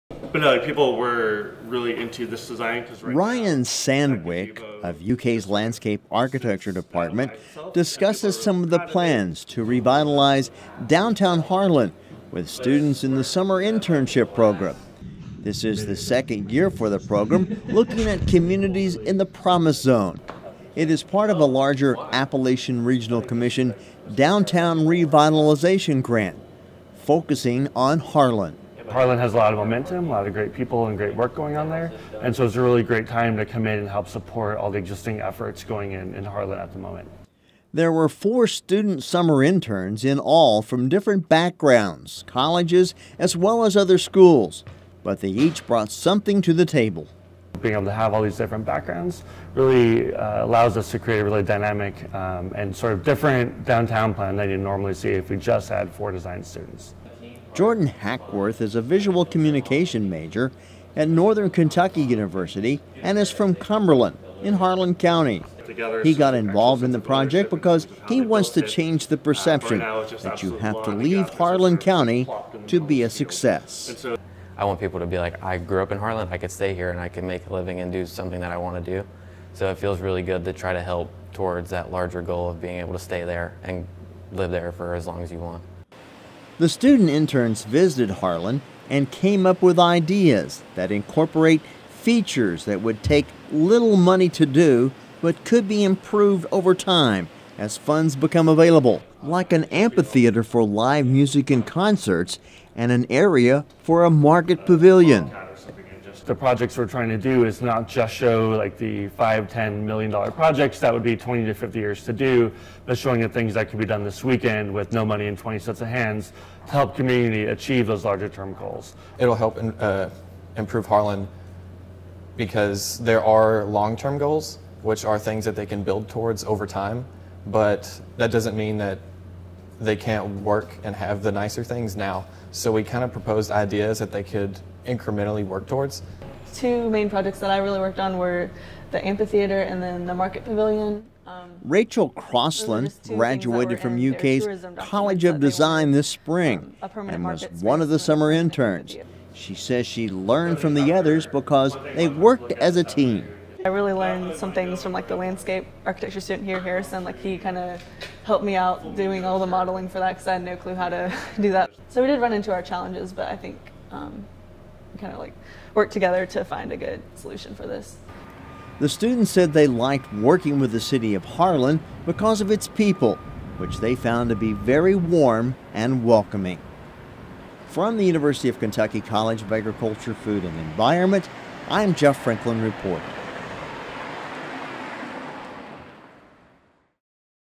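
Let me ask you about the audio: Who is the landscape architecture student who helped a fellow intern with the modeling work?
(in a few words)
Harrison.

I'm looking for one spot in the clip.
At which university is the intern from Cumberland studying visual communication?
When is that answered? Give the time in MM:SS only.
01:01.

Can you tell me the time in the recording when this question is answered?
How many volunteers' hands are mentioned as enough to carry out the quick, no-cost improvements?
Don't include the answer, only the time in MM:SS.
01:55.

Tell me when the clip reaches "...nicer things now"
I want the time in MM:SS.
02:11.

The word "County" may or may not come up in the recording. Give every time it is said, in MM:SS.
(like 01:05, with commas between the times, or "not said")
01:04, 01:11.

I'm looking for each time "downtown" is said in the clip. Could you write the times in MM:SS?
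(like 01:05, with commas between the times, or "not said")
00:10, 00:24, 00:53.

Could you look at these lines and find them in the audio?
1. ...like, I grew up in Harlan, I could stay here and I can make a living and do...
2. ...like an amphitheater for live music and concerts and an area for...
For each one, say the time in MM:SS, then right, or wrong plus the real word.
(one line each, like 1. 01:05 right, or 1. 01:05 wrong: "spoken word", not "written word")
1. 01:15 right
2. 01:39 right.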